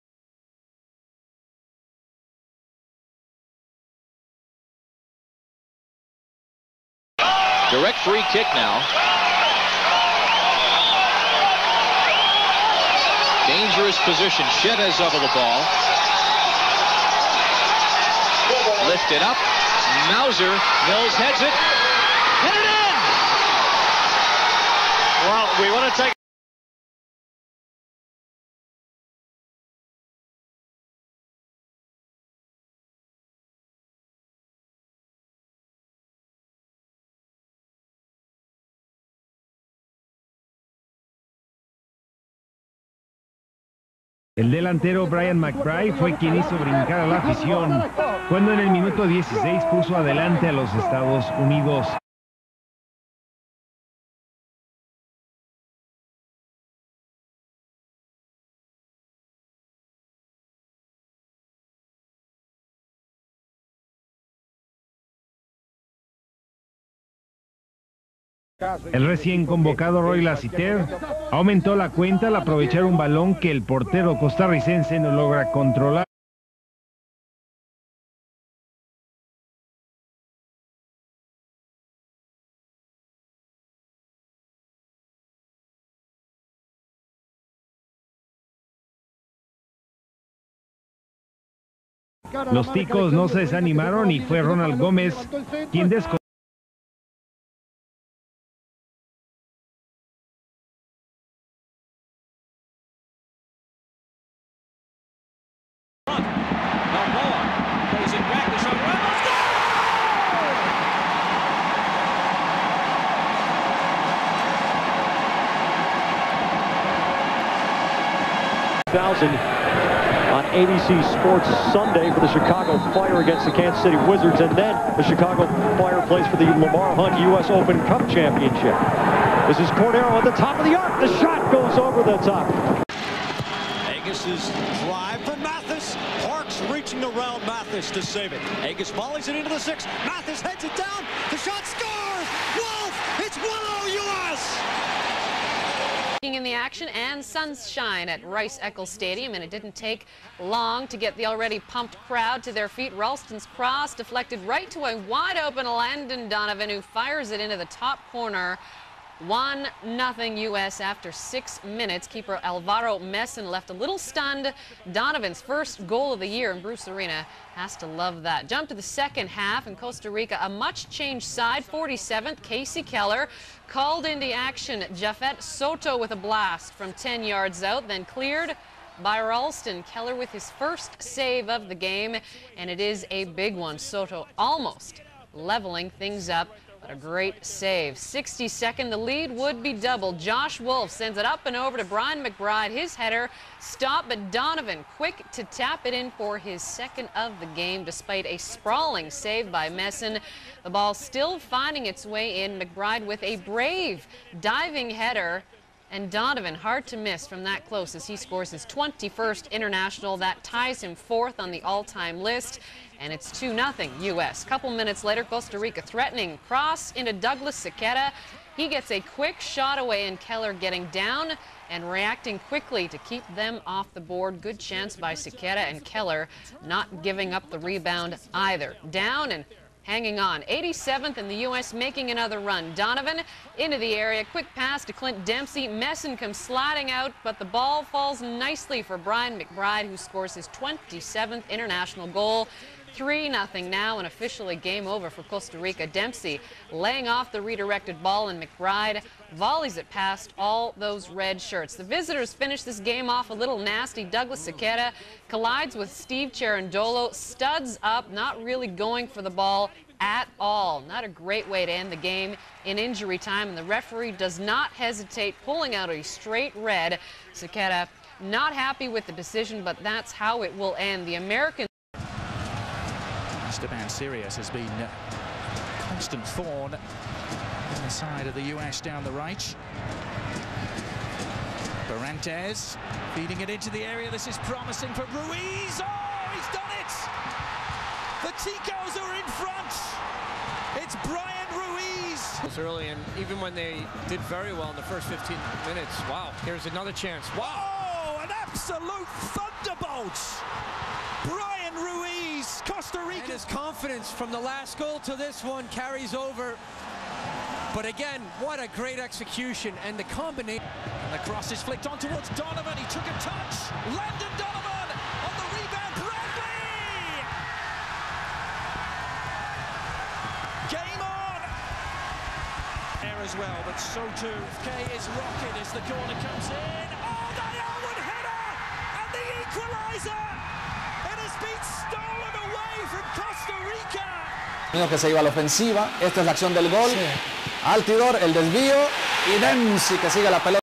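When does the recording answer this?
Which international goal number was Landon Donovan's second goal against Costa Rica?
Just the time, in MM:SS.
03:28.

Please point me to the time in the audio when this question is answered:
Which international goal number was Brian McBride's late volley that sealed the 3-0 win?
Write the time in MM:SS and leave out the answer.
04:00.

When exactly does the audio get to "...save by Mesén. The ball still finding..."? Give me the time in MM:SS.
03:19.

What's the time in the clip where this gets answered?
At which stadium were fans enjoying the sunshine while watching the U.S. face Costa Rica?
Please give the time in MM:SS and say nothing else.
02:28.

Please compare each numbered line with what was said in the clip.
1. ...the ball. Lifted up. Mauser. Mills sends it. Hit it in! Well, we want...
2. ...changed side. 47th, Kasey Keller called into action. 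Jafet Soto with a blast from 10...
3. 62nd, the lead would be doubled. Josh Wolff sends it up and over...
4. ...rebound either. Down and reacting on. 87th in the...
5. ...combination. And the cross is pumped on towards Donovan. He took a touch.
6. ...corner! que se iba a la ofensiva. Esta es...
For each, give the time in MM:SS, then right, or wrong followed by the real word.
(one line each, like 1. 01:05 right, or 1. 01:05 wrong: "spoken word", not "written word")
1. 00:15 wrong: "heads", not "sends"
2. 02:50 right
3. 03:07 right
4. 03:47 wrong: "hanging", not "reacting"
5. 05:10 wrong: "flicked", not "pumped"
6. 05:29 wrong: "equaliser", not "corner".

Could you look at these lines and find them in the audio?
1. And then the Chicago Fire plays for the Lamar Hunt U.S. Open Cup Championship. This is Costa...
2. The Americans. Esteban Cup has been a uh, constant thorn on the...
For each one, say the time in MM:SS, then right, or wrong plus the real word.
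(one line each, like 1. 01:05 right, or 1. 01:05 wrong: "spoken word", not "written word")
1. 02:04 wrong: "Cordero", not "Costa"
2. 04:31 wrong: "Sirius", not "Cup".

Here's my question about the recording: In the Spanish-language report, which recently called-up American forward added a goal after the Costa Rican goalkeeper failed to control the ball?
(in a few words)
Roy Lassiter.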